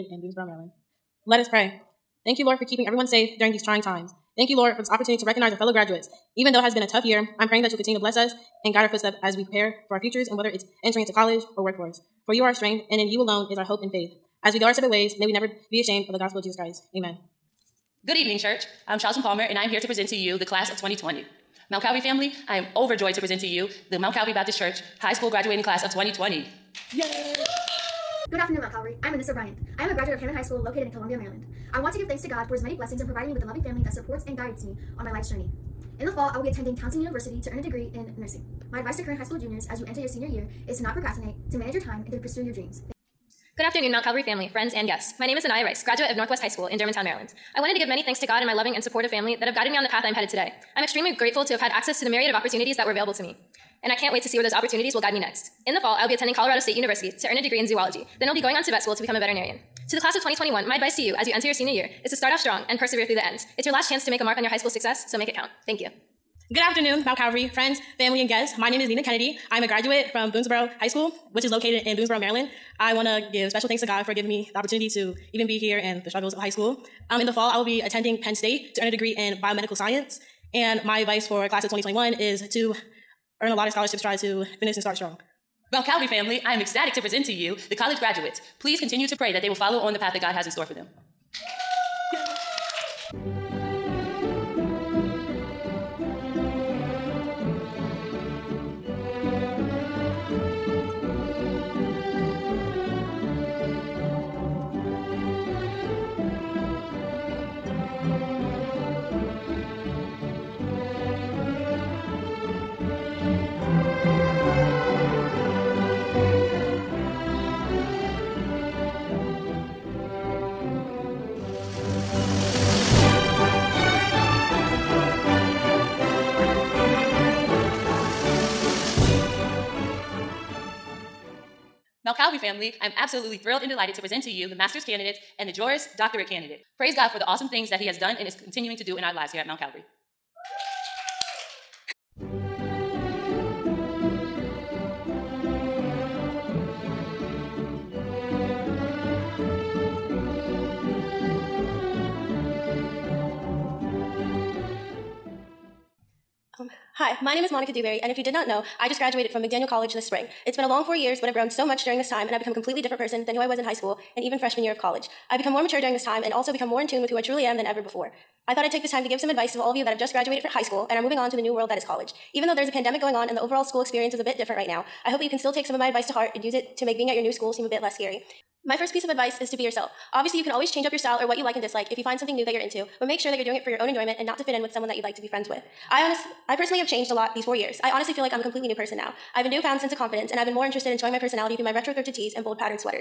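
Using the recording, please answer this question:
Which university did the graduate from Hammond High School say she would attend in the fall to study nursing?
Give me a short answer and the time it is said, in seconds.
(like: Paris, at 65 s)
Towson University, at 36 s.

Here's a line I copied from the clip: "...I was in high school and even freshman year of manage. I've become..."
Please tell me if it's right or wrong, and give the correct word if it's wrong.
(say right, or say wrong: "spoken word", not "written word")
wrong: "college", not "manage".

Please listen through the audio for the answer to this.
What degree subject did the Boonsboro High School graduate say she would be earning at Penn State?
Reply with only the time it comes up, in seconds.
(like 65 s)
79 s.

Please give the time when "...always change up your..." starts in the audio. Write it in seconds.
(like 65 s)
180 s.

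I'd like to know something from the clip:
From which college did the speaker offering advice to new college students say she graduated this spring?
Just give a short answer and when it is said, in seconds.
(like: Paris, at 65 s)
McDaniel College, at 159 s.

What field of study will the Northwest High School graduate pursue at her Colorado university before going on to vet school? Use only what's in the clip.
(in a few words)
zoology.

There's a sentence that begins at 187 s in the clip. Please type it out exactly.
I honestly feel like I'm a completely new person now.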